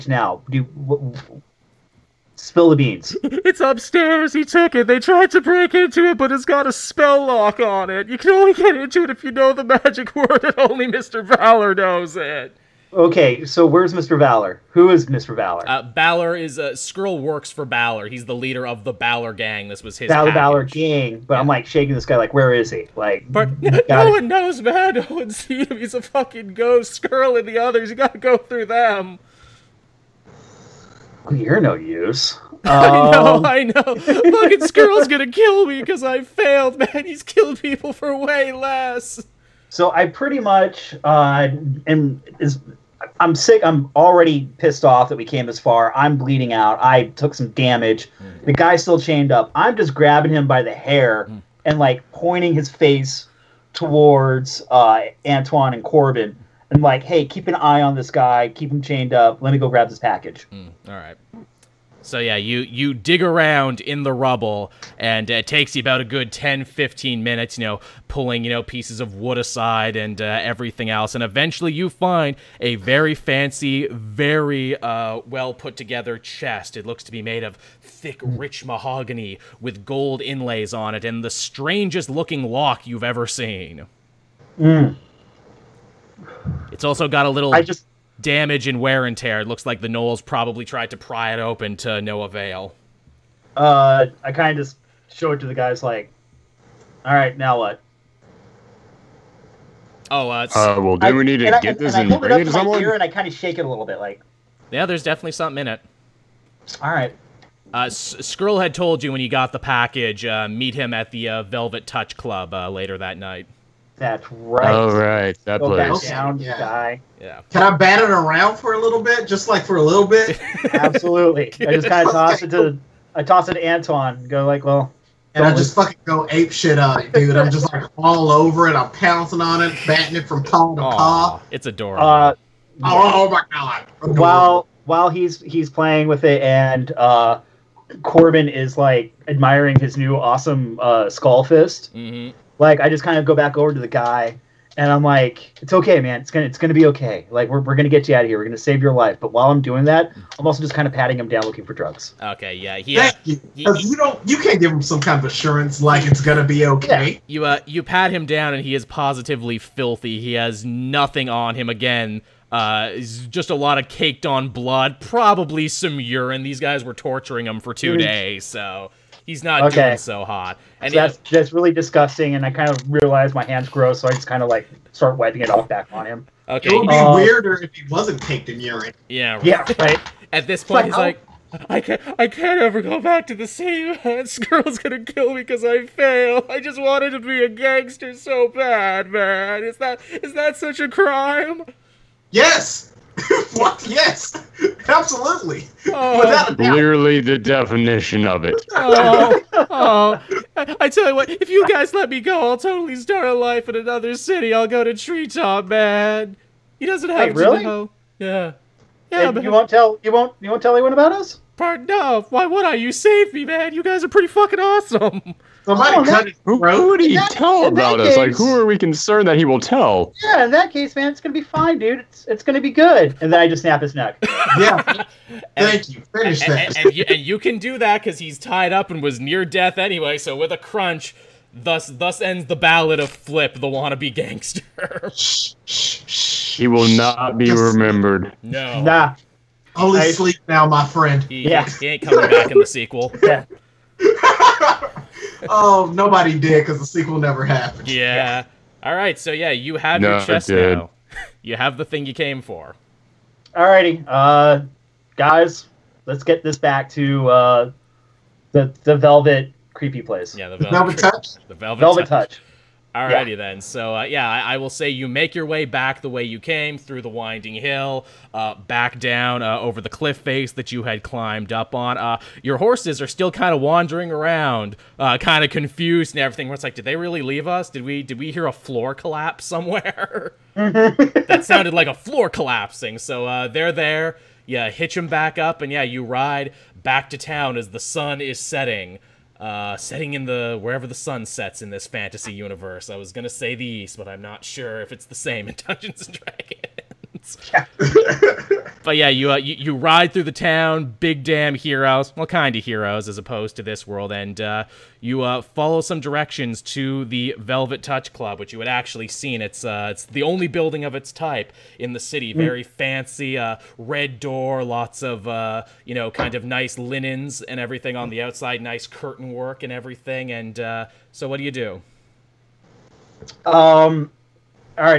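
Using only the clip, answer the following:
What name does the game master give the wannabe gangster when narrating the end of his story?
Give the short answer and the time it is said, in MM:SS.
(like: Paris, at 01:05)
Flip, at 03:53.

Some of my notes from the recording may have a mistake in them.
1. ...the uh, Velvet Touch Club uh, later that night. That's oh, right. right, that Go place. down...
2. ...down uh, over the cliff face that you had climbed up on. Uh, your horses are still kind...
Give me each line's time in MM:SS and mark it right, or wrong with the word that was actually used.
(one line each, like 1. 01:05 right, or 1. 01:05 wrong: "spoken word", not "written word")
1. 01:51 right
2. 04:28 right.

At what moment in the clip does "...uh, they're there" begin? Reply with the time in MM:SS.
04:43.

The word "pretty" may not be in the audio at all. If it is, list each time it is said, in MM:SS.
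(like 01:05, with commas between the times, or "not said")
00:40, 03:34.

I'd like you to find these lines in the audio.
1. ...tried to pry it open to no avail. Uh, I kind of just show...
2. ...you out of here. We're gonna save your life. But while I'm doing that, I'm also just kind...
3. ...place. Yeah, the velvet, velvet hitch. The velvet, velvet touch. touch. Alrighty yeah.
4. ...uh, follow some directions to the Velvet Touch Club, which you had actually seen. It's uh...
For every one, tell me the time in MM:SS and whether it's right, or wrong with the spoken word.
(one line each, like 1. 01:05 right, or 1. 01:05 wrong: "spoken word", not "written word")
1. 01:30 right
2. 02:28 right
3. 04:20 wrong: "touch", not "hitch"
4. 05:05 right.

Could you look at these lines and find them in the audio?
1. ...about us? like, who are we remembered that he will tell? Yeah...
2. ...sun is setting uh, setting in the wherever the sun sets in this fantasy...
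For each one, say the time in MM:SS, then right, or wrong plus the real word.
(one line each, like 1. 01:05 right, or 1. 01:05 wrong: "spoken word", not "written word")
1. 03:37 wrong: "concerned", not "remembered"
2. 04:47 right.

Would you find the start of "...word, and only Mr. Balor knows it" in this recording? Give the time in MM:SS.
00:10.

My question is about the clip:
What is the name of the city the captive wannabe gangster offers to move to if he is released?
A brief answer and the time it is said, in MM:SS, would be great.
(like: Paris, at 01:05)
Treetop, at 03:24.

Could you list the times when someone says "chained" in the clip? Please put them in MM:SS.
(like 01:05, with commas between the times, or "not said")
00:48, 00:58.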